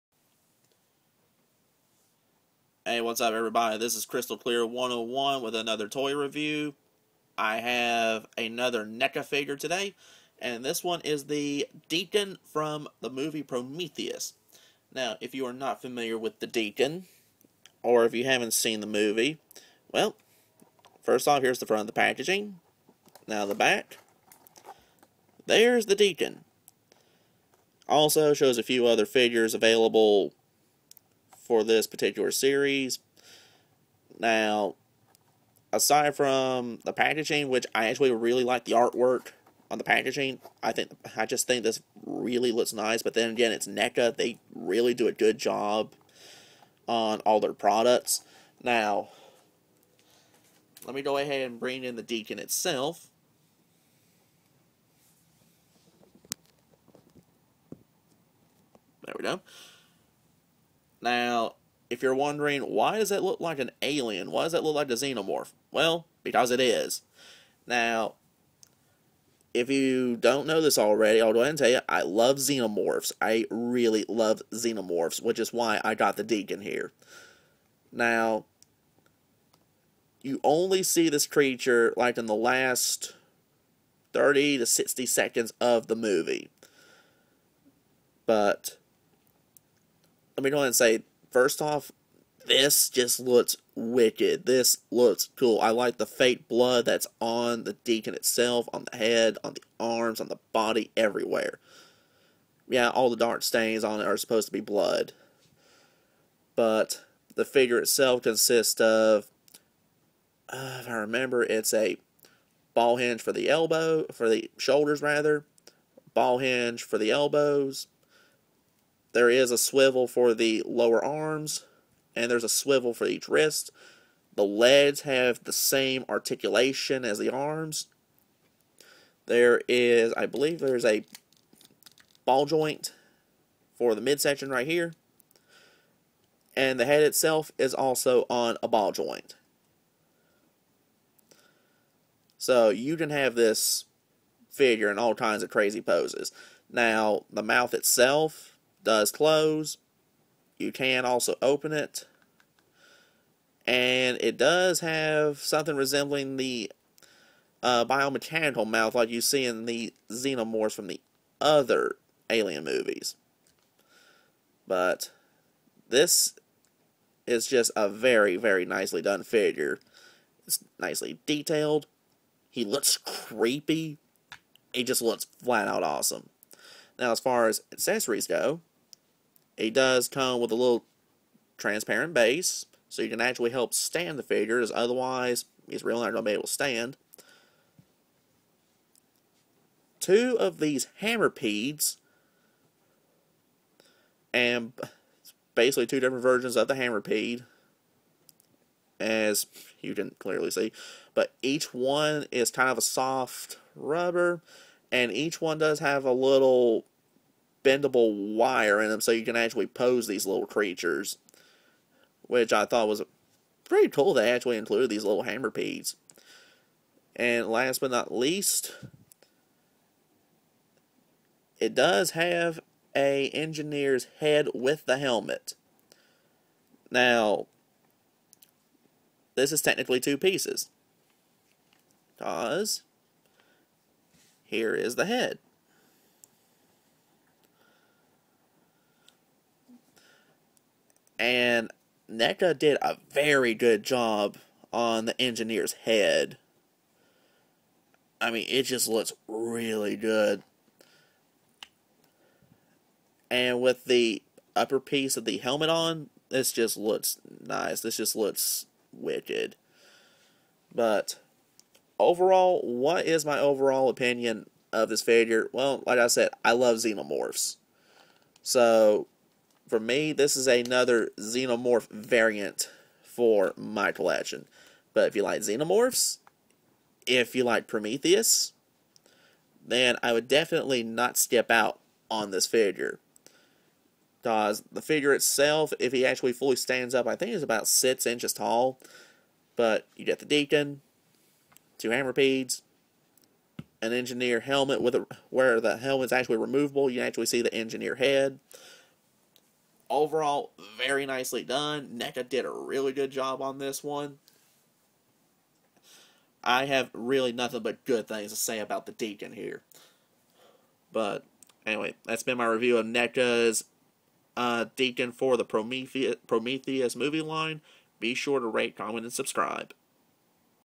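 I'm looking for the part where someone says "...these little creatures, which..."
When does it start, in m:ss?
3:30.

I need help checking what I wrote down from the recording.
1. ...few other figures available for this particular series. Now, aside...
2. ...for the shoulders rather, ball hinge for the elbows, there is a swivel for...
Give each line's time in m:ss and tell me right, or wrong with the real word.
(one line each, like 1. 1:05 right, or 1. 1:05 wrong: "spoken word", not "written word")
1. 0:28 right
2. 1:54 right.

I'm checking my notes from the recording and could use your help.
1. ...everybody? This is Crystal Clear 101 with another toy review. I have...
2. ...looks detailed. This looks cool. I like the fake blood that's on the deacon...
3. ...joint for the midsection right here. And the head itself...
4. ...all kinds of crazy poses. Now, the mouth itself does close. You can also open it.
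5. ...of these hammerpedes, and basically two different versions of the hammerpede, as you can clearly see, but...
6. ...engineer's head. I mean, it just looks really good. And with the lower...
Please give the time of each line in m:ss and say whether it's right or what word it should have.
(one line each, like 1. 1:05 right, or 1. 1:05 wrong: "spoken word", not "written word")
1. 0:03 right
2. 1:33 wrong: "wicked", not "detailed"
3. 2:12 right
4. 2:24 right
5. 3:10 right
6. 4:05 wrong: "upper", not "lower".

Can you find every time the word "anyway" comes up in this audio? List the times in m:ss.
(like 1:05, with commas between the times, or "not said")
5:11.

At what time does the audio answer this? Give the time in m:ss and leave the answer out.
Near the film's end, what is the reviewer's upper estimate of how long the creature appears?
1:24.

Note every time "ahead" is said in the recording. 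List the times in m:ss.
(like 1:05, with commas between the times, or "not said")
0:51, 1:11, 1:30.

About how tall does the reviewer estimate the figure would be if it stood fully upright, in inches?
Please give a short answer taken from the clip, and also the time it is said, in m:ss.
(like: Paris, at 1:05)
6 inches, at 4:47.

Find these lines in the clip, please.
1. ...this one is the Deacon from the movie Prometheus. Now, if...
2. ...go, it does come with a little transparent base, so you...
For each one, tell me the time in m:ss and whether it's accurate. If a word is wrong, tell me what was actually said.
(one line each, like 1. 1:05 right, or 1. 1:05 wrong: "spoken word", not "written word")
1. 0:10 right
2. 2:58 right.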